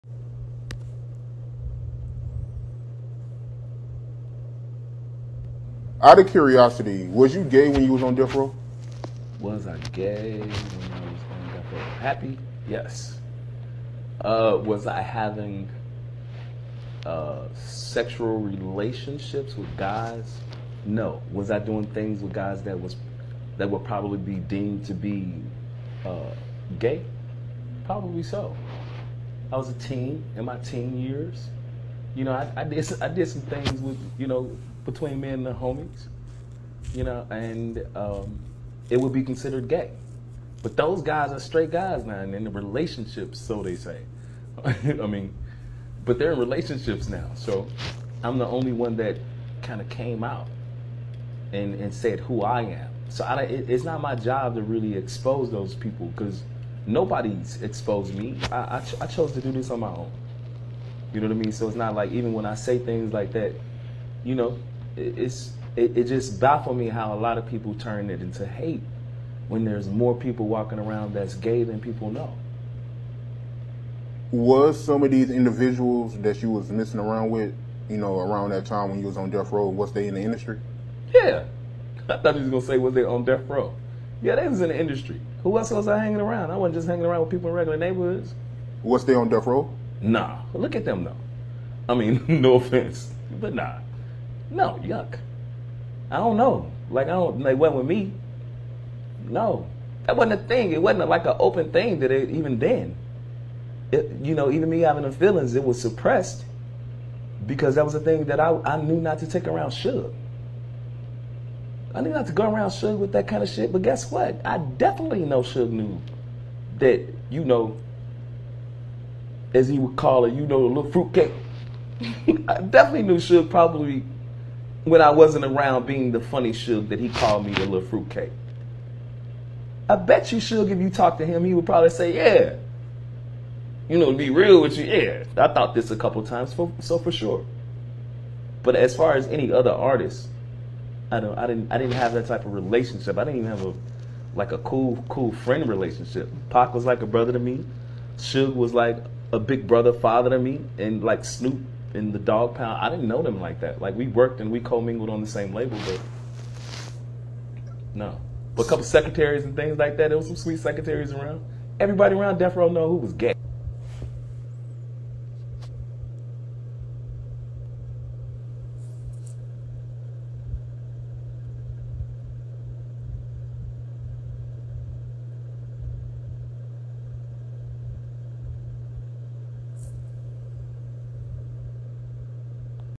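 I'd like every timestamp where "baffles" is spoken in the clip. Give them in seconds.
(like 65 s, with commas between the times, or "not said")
66 s.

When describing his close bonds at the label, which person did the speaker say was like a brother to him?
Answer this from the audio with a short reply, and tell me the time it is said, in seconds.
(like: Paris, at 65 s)
Pac, at 146 s.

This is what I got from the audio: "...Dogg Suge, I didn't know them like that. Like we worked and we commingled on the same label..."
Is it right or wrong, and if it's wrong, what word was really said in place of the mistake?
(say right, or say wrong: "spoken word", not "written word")
wrong: "Pound", not "Suge".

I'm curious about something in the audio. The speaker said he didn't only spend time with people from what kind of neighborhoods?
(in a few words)
regular neighborhoods.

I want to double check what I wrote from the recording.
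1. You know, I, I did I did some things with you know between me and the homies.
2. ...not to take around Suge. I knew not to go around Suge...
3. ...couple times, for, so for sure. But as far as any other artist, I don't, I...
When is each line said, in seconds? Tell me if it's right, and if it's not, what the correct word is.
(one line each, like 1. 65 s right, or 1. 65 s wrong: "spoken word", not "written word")
1. 32 s right
2. 108 s right
3. 135 s right.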